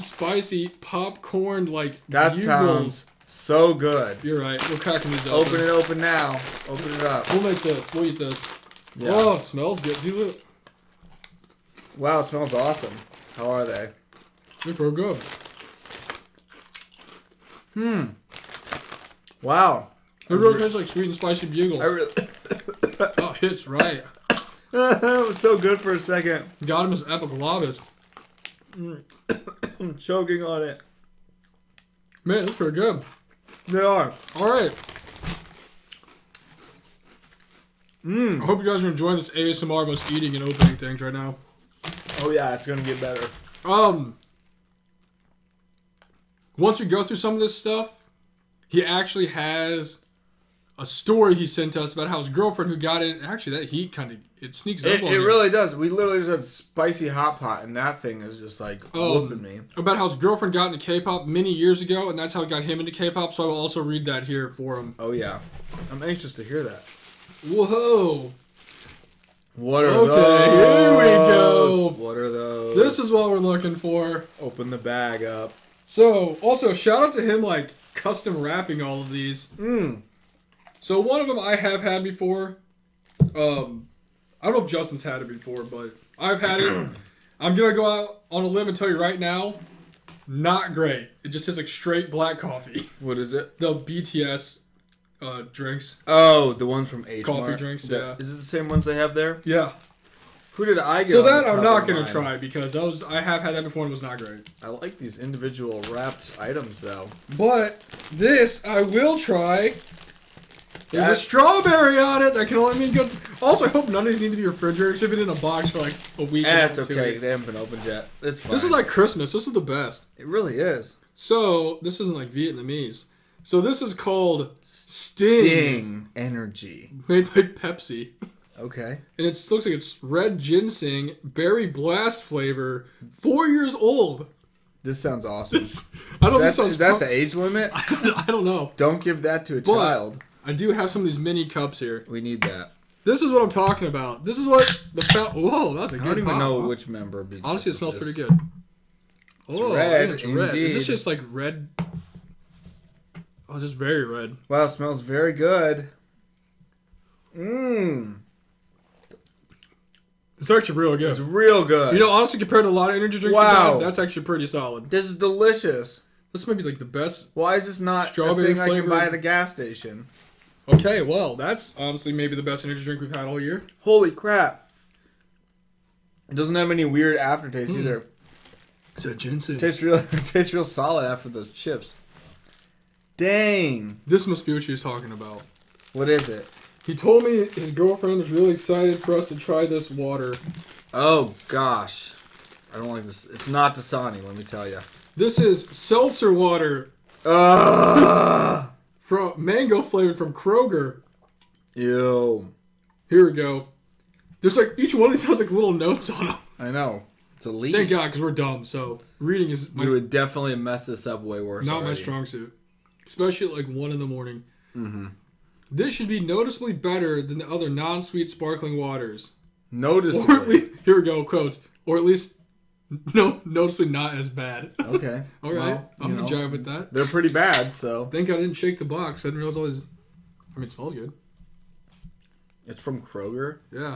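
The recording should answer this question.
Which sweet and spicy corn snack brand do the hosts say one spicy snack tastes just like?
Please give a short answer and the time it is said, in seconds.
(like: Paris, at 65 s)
Bugles, at 21 s.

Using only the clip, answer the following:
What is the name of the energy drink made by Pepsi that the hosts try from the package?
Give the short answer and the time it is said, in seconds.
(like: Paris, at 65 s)
Sting, at 125 s.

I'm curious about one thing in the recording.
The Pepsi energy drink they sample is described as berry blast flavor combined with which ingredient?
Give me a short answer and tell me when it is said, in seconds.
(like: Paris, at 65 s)
red ginseng, at 130 s.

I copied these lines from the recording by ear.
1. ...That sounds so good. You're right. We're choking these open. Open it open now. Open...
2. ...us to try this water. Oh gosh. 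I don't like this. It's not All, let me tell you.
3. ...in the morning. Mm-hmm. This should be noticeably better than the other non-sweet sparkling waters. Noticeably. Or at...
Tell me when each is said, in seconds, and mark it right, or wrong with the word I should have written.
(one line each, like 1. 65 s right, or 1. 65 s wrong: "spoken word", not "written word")
1. 2 s wrong: "cracking", not "choking"
2. 189 s wrong: "Dasani", not "All"
3. 213 s right.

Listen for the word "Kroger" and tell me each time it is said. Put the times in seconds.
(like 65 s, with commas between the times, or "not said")
200 s, 233 s.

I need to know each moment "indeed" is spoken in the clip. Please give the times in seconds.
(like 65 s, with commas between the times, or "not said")
150 s.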